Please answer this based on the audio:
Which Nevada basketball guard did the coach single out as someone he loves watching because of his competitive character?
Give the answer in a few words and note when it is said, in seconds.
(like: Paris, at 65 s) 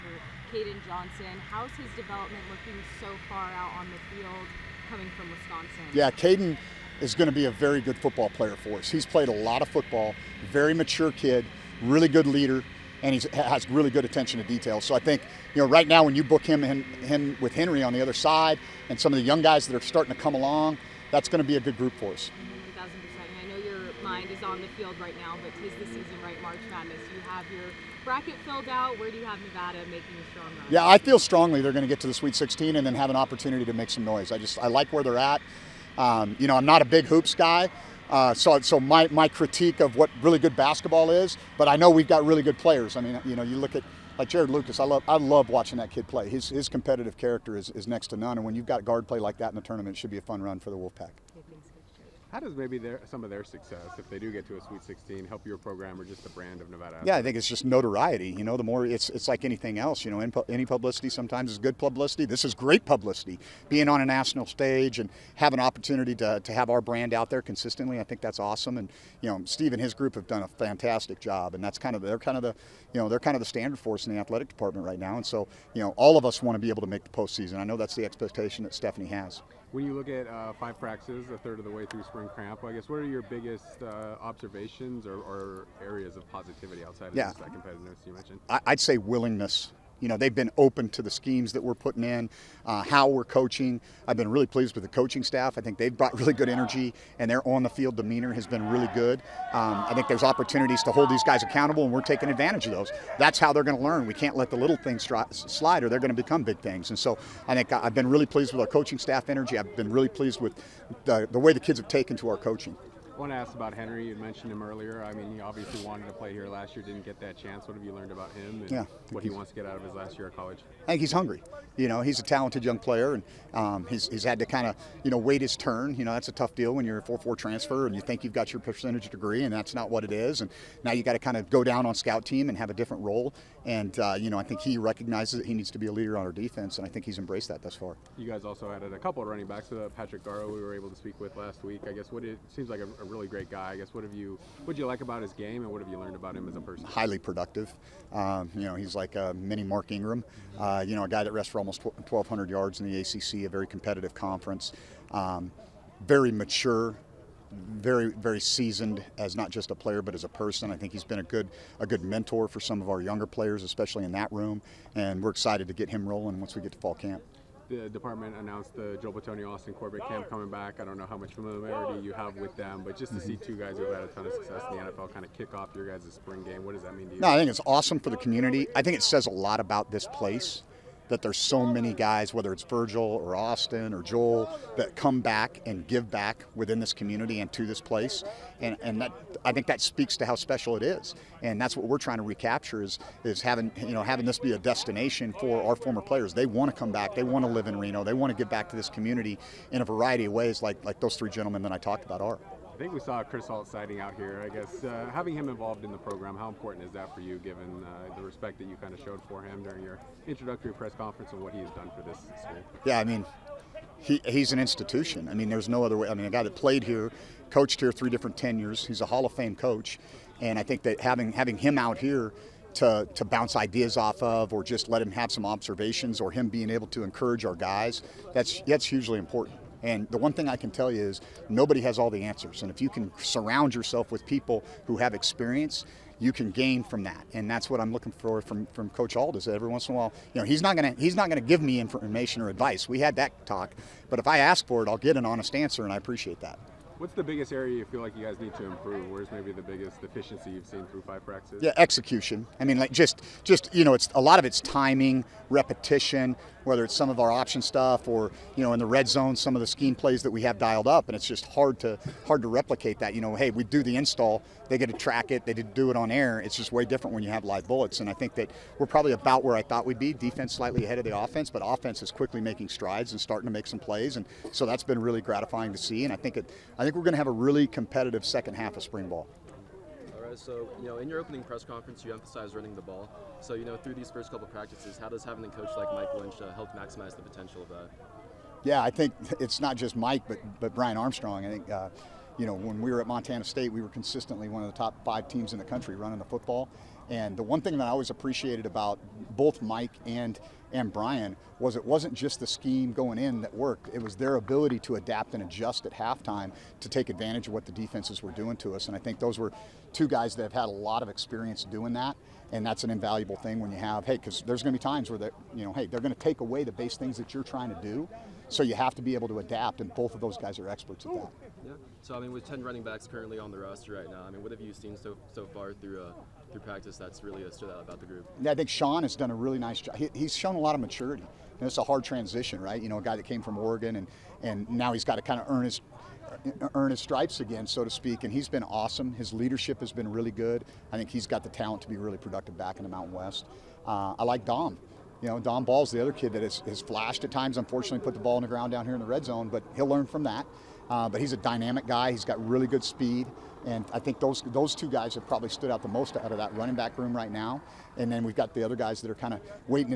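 Jarod Lucas, at 44 s.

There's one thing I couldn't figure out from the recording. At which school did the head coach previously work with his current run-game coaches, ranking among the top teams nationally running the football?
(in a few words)
Montana State.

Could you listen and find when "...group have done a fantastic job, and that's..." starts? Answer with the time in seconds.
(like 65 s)
69 s.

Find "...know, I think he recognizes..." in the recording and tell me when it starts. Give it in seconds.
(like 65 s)
134 s.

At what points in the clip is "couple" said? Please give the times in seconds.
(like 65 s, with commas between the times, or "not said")
138 s, 284 s.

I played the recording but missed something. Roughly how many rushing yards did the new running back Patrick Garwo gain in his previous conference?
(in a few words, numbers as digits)
1,200.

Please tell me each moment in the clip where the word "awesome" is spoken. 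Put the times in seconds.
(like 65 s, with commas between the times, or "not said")
68 s, 177 s, 338 s.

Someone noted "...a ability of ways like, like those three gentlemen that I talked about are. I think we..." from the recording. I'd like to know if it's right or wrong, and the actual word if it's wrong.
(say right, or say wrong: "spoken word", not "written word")
wrong: "variety", not "ability".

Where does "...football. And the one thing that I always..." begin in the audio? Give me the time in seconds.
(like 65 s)
296 s.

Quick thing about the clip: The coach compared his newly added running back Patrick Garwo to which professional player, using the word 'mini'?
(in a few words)
Mark Ingram.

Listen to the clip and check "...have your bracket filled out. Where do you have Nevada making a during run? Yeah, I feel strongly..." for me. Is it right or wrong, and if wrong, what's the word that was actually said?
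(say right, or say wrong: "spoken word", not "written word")
wrong: "strong", not "during".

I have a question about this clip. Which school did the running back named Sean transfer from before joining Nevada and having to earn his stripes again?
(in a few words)
Oregon.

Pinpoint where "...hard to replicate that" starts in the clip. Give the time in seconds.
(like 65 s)
262 s.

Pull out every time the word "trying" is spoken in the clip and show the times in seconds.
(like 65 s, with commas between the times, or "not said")
191 s, 317 s.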